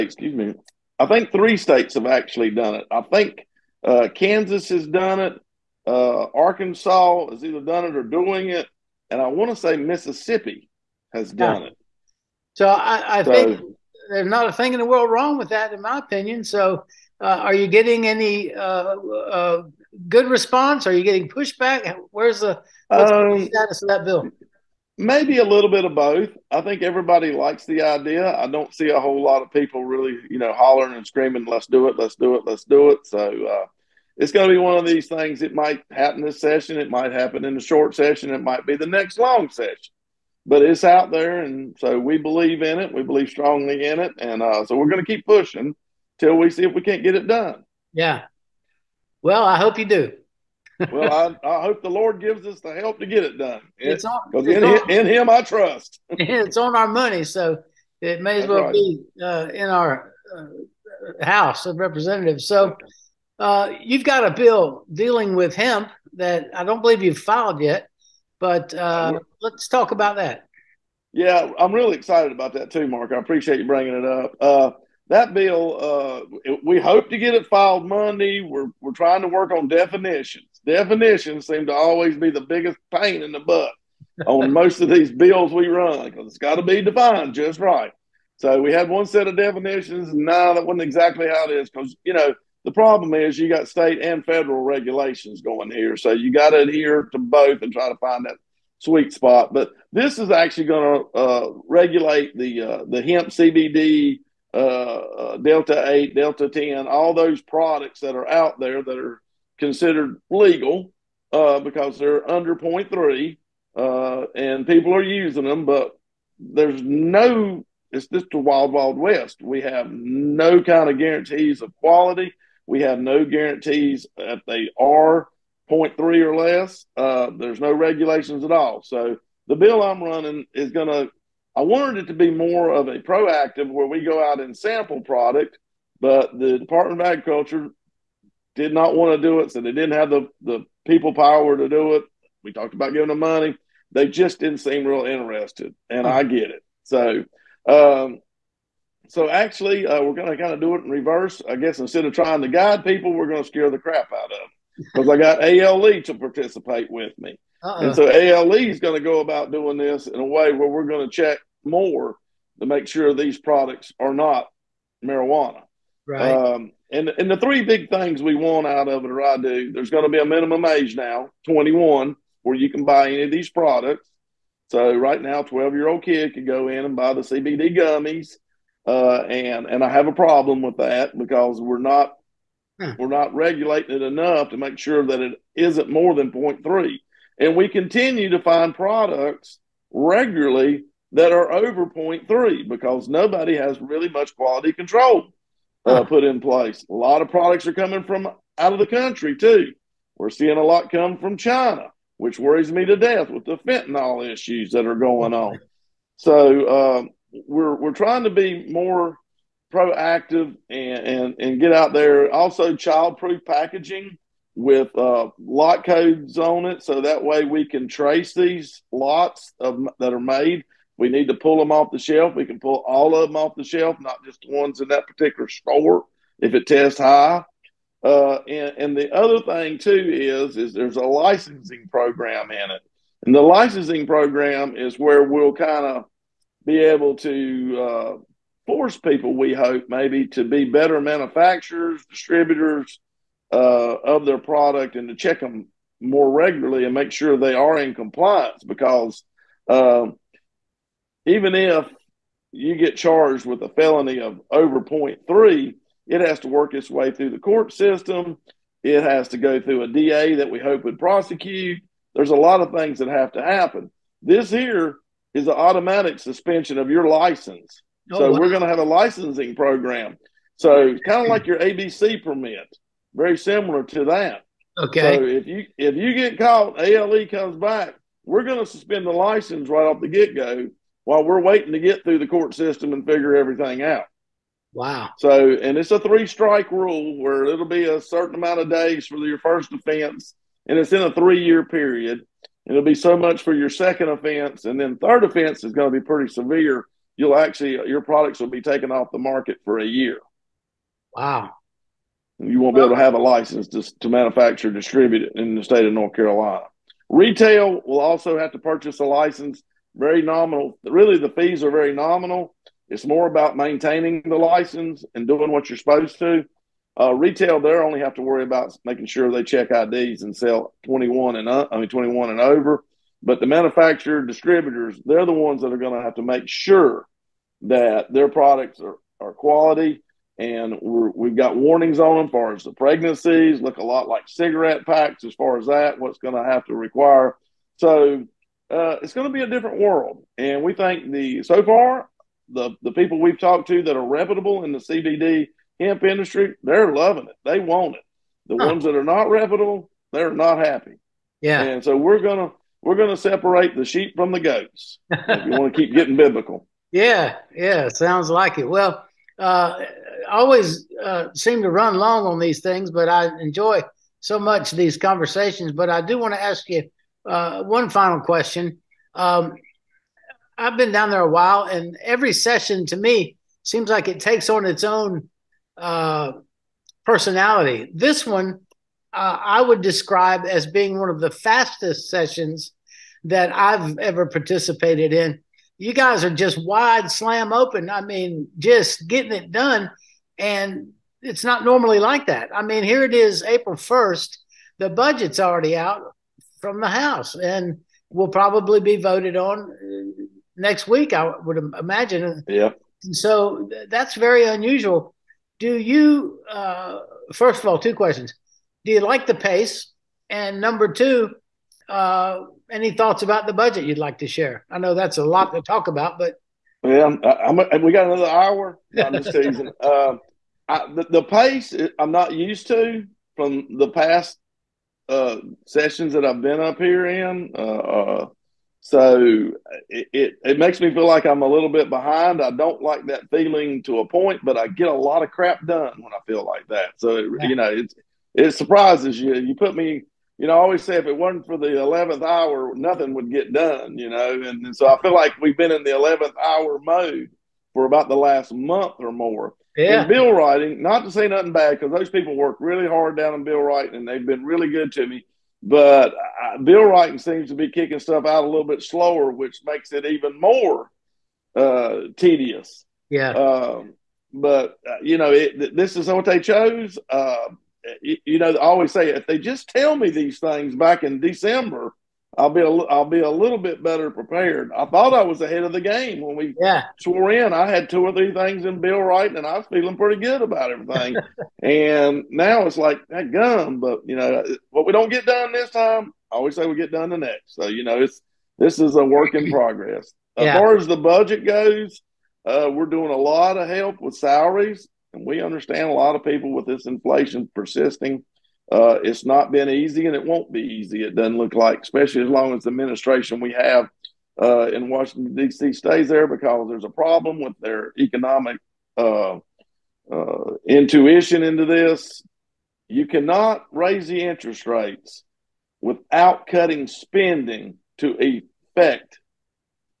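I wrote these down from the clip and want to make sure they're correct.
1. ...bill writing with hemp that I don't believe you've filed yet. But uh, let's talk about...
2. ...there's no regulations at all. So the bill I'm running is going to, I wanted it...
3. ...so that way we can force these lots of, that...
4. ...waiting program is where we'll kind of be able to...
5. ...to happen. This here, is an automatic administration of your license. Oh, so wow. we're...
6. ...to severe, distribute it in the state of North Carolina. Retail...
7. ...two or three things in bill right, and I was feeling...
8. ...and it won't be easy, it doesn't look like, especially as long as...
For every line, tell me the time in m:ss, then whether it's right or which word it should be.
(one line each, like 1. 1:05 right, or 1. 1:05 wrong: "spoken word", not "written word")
1. 1:04 wrong: "dealing", not "writing"
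2. 2:07 right
3. 3:36 wrong: "trace", not "force"
4. 3:53 wrong: "licensing", not "waiting"
5. 4:23 wrong: "suspension", not "administration"
6. 5:04 wrong: "manufacture", not "severe"
7. 7:57 right
8. 8:20 right.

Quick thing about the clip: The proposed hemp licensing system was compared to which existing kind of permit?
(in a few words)
ABC permit.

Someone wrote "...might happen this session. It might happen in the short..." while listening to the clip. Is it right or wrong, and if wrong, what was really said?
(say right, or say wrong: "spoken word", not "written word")
right.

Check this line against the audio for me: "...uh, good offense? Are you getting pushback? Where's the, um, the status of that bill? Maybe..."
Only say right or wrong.
wrong.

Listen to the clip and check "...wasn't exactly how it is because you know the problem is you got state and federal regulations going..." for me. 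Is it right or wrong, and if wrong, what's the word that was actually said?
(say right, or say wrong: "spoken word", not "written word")
right.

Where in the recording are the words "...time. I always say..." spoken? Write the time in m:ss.
8:05.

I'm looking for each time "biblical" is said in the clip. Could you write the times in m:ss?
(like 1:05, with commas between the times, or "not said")
5:56.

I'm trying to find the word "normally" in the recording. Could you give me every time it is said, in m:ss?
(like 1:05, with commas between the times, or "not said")
6:31.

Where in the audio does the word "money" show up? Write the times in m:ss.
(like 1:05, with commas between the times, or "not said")
0:56, 2:23.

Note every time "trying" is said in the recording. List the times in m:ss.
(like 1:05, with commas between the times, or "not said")
1:18, 2:32, 3:27.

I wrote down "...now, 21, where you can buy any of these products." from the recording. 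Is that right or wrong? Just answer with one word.
right.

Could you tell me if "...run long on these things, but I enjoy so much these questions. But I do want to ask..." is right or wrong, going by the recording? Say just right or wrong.
wrong.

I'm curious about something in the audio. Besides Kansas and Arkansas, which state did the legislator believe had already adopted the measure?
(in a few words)
Mississippi.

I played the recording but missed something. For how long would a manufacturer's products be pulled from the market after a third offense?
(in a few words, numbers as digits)
a year.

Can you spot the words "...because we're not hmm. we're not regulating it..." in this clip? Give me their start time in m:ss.
3:01.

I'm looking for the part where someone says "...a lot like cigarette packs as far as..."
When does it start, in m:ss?
5:33.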